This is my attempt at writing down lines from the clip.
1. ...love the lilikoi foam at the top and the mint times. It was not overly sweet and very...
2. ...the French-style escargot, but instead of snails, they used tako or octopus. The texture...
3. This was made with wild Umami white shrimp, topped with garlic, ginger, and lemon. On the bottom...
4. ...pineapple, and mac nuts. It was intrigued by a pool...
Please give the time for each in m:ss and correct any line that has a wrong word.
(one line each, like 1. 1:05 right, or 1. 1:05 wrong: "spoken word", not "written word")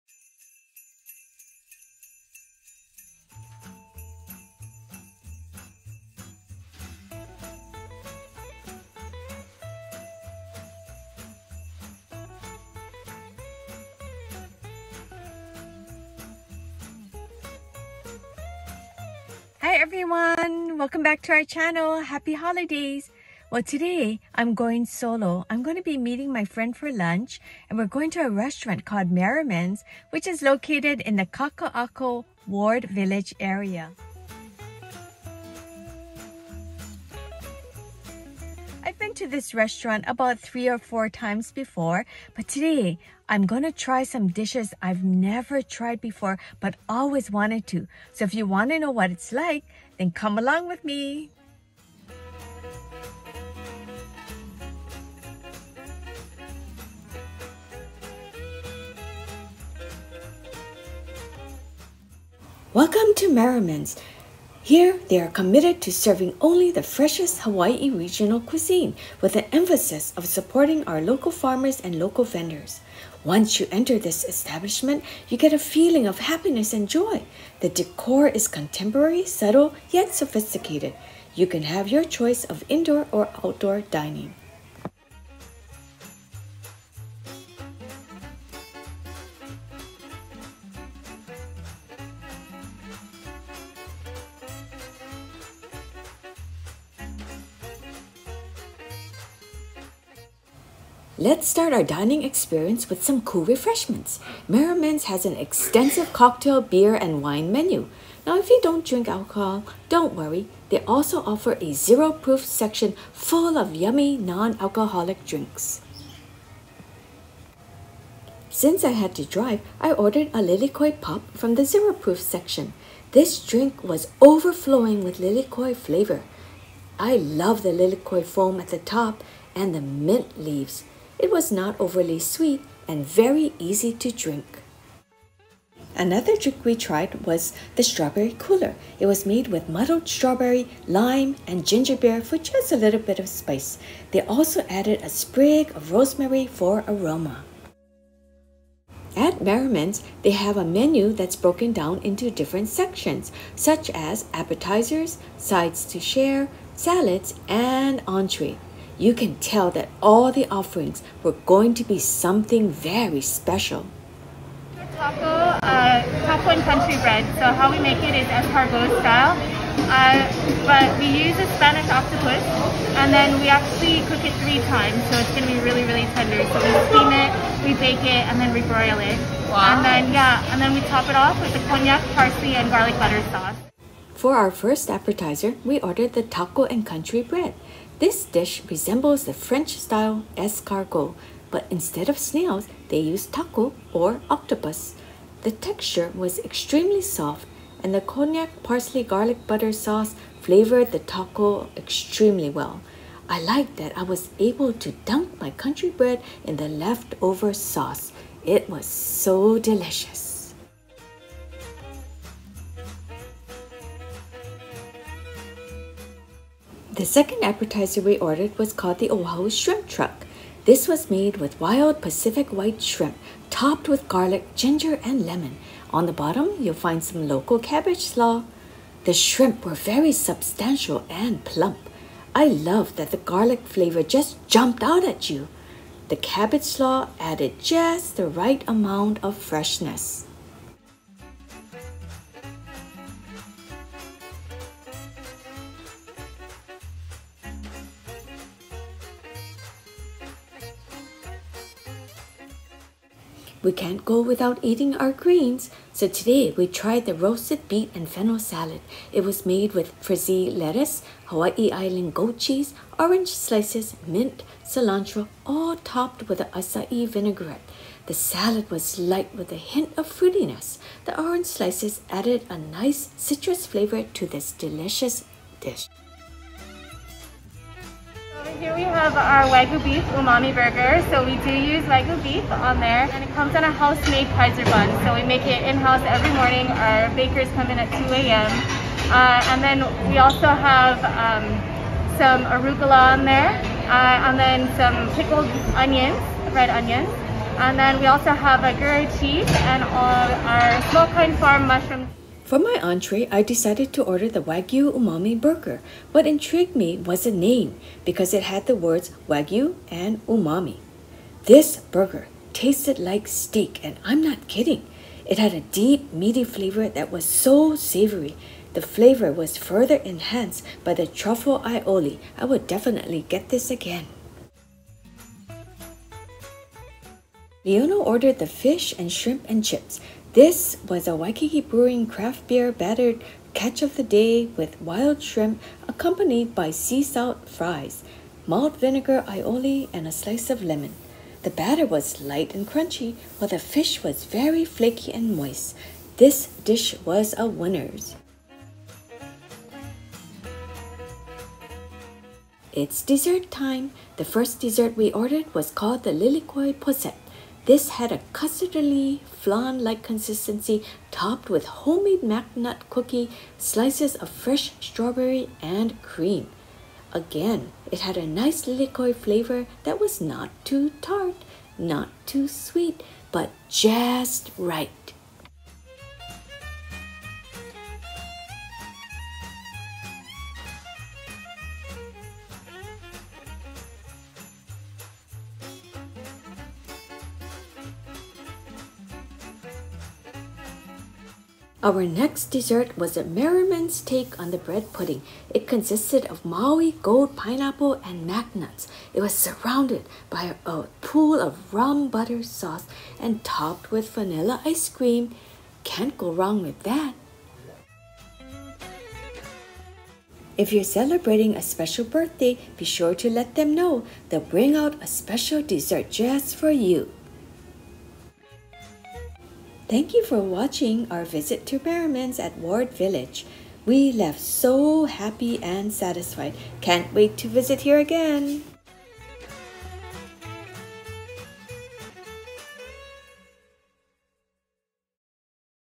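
1. 2:07 wrong: "leaves", not "times"
2. 3:09 right
3. 3:40 wrong: "Pacific", not "Umami"
4. 6:37 wrong: "surrounded", not "intrigued".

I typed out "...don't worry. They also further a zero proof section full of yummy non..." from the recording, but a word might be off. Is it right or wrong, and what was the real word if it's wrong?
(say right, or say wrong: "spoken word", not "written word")
wrong: "offer", not "further".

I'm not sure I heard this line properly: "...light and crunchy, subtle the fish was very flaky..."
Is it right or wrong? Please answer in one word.
wrong.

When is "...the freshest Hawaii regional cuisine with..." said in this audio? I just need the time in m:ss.
1:06.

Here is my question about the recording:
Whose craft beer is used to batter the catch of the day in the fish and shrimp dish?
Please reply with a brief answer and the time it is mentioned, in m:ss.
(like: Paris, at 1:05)
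Waikiki Brewing, at 5:31.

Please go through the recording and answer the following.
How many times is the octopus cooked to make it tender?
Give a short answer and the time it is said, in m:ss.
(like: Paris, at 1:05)
3, at 2:54.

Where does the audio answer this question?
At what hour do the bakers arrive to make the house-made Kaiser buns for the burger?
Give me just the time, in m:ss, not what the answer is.
4:47.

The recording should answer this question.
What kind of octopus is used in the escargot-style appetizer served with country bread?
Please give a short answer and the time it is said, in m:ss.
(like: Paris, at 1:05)
Spanish octopus, at 2:51.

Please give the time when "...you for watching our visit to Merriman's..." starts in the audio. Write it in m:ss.
7:00.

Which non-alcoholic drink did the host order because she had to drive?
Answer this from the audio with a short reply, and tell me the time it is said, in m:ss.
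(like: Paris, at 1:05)
lilikoi pop, at 2:00.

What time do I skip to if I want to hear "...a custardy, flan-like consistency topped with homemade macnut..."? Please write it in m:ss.
5:58.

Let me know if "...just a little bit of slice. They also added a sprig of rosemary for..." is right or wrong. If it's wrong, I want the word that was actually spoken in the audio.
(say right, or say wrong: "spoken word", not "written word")
wrong: "spice", not "slice".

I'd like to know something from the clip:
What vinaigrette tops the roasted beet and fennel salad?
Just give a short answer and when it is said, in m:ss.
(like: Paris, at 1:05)
acai vinaigrette, at 4:26.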